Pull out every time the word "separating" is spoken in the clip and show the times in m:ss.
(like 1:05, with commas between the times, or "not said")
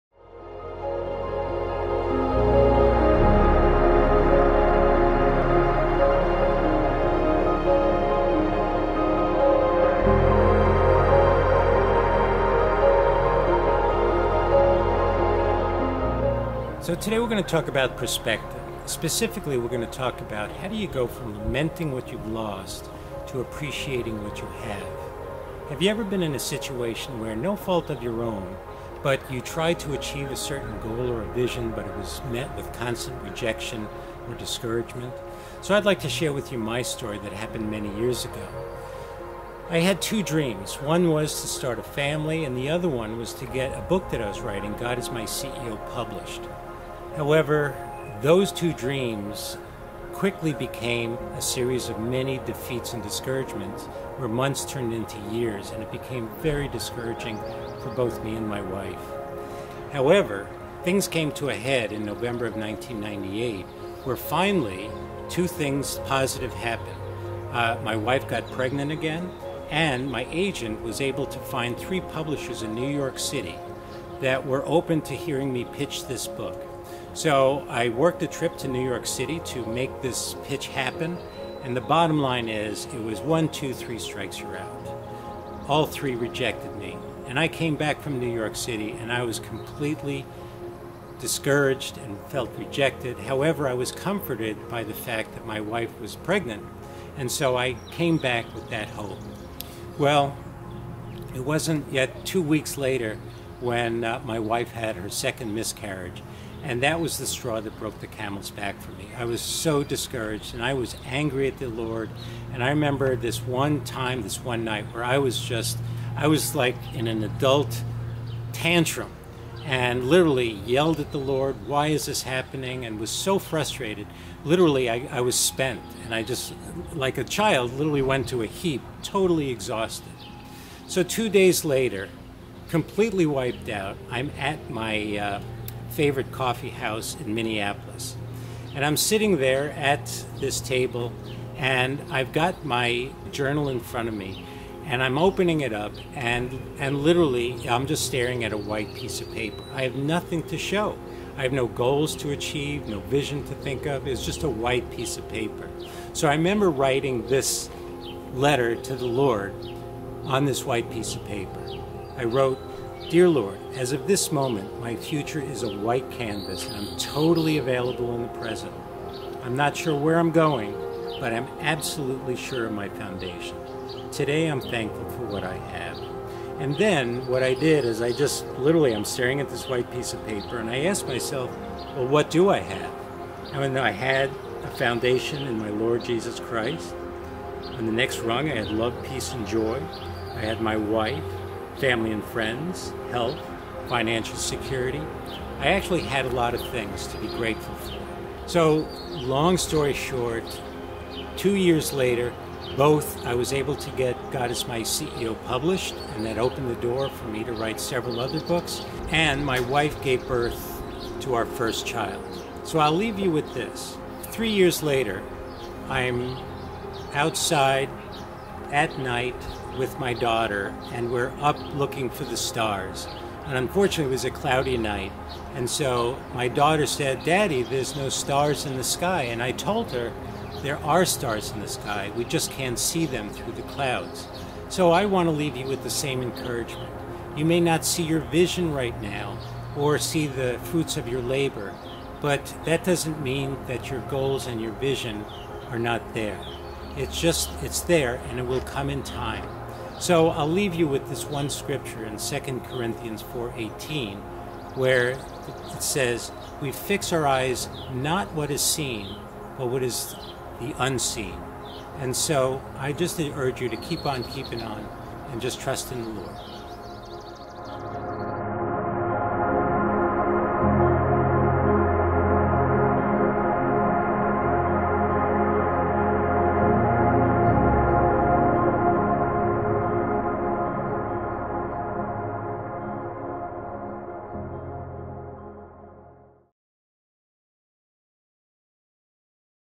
not said.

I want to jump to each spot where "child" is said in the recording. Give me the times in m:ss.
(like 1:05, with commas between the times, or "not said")
2:07, 3:31.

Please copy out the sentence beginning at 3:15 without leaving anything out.
I actually had a lot of things to be grateful for.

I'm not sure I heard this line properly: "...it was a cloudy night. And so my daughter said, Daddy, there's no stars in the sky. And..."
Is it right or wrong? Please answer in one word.
right.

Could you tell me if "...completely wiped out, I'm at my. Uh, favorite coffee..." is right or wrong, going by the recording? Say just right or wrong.
right.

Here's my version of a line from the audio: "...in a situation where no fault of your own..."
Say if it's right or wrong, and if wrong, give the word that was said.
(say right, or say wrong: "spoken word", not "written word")
right.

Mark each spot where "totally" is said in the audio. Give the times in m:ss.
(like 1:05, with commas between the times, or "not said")
2:09, 2:46.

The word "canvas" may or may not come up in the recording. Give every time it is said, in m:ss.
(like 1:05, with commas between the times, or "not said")
2:46.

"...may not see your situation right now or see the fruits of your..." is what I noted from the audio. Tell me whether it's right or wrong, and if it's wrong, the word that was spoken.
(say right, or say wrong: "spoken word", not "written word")
wrong: "vision", not "situation".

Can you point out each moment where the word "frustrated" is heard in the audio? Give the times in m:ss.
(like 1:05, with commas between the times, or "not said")
2:03.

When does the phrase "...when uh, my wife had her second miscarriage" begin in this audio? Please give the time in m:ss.
1:43.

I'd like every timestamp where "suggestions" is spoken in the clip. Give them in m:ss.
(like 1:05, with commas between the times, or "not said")
not said.